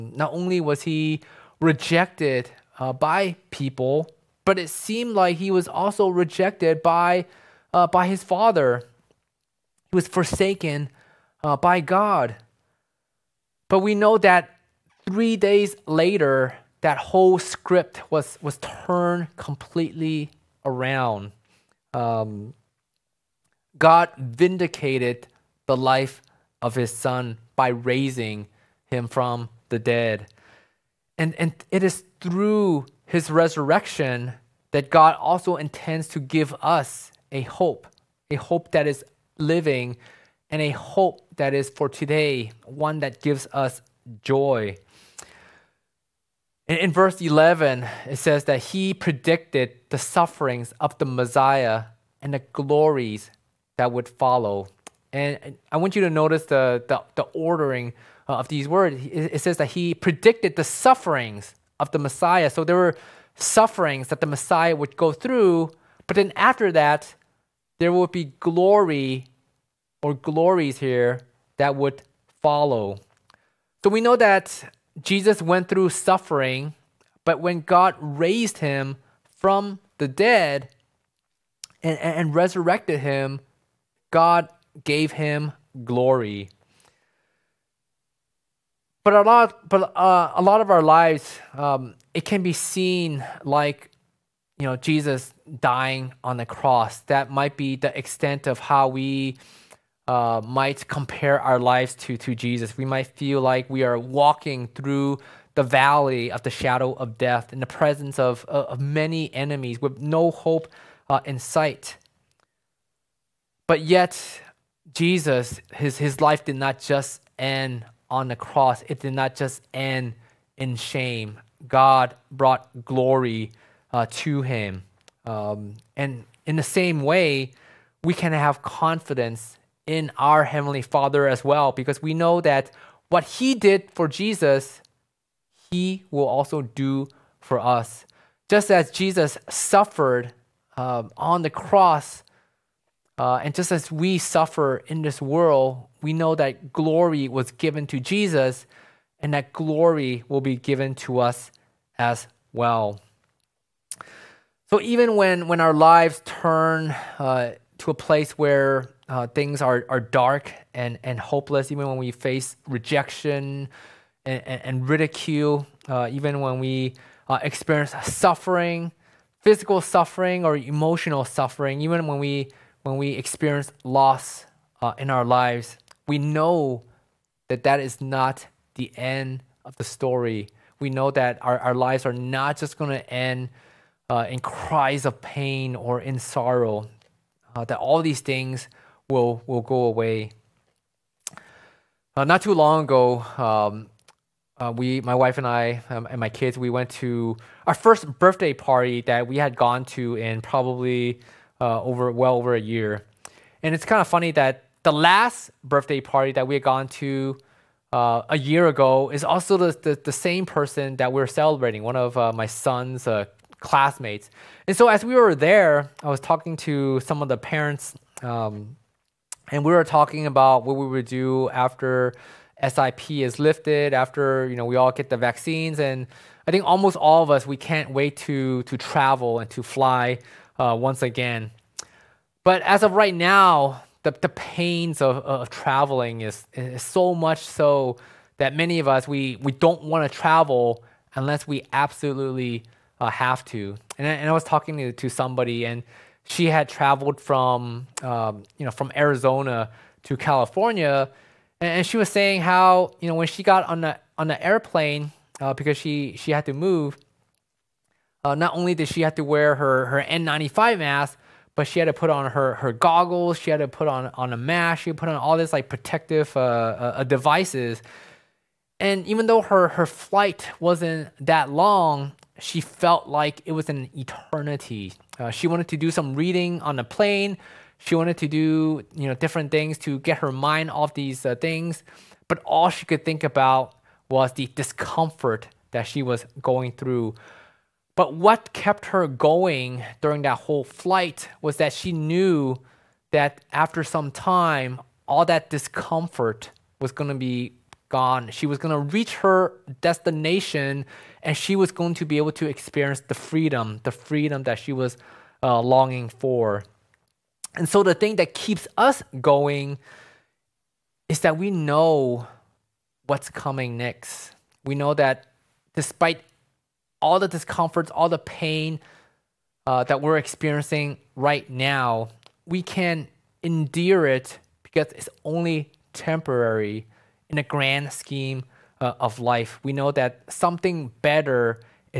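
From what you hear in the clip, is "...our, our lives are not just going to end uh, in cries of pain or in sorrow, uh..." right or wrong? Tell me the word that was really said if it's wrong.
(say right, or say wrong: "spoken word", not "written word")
right.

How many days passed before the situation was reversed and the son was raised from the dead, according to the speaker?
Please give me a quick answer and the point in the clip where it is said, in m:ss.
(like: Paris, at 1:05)
3, at 0:15.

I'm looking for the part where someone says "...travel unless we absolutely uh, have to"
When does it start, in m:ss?
4:00.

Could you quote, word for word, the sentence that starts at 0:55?
And I want you to notice the, the, the ordering uh, of these words.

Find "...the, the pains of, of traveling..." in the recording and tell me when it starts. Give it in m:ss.
3:54.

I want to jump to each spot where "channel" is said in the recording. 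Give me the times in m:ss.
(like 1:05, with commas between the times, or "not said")
not said.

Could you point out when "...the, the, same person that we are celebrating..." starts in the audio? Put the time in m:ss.
3:29.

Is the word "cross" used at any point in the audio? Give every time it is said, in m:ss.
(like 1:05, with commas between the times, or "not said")
1:36, 1:58, 2:21.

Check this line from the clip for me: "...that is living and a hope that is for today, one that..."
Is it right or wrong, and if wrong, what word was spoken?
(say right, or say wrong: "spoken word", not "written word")
right.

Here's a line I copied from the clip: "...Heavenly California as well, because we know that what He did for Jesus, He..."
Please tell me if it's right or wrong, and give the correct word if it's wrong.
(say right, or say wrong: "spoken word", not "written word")
wrong: "Father", not "California".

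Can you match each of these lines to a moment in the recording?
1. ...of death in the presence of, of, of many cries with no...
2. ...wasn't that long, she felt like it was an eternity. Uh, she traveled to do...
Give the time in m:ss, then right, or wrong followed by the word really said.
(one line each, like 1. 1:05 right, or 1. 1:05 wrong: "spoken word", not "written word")
1. 1:46 wrong: "enemies", not "cries"
2. 4:30 wrong: "wanted", not "traveled".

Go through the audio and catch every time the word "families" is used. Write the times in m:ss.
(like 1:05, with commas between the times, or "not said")
not said.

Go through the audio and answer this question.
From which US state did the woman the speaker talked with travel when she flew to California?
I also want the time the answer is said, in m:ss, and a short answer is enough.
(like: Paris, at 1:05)
Arizona, at 4:08.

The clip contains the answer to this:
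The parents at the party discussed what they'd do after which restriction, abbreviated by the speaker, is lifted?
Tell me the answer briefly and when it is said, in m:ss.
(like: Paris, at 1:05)
SIP, at 3:42.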